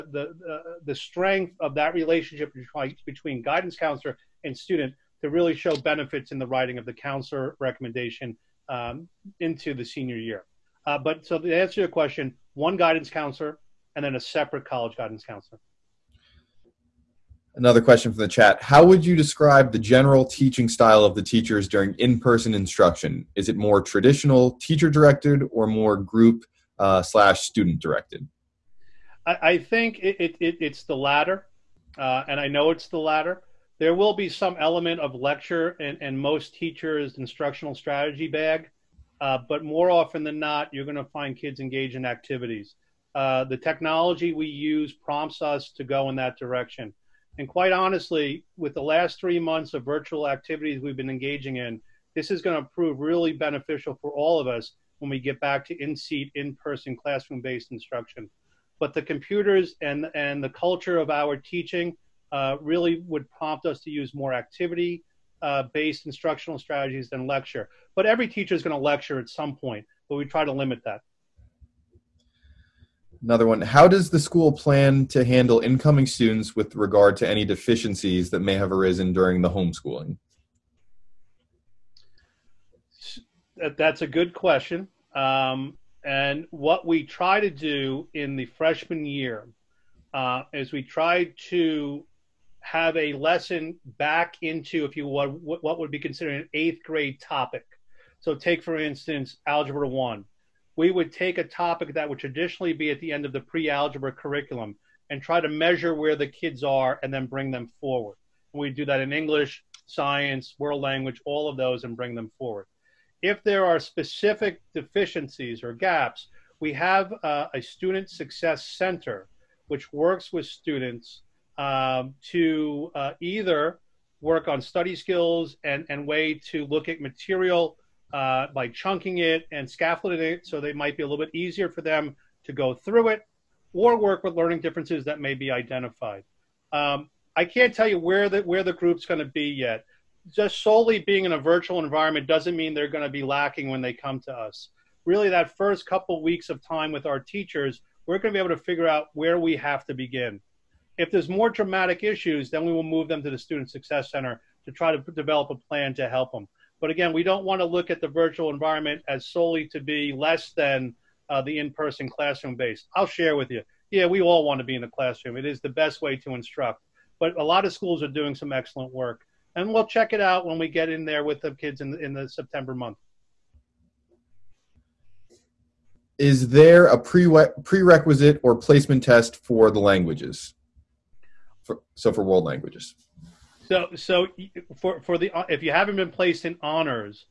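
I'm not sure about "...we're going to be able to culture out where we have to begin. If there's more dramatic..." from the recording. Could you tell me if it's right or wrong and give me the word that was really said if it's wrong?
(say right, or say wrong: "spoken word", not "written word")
wrong: "figure", not "culture".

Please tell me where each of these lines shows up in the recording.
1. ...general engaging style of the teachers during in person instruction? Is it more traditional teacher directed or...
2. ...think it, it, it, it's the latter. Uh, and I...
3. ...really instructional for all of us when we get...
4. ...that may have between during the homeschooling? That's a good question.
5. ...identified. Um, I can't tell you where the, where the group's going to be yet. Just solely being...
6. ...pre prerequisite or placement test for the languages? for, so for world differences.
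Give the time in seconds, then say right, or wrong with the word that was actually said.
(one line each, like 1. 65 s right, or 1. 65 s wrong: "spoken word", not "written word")
1. 19 s wrong: "teaching", not "engaging"
2. 29 s right
3. 52 s wrong: "beneficial", not "instructional"
4. 78 s wrong: "arisen", not "between"
5. 135 s right
6. 176 s wrong: "languages", not "differences".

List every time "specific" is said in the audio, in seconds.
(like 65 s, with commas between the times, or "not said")
113 s.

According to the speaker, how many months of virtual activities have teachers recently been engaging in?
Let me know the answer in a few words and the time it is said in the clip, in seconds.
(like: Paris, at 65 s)
3, at 49 s.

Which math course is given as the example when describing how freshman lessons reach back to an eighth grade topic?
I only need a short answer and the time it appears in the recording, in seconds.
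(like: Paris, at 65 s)
Algebra One, at 99 s.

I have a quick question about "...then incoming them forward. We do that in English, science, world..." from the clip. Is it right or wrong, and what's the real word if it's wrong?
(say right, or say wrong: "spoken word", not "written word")
wrong: "bring", not "incoming".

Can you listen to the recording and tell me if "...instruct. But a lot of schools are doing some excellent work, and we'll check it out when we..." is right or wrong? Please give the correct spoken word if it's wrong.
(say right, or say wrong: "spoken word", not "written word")
right.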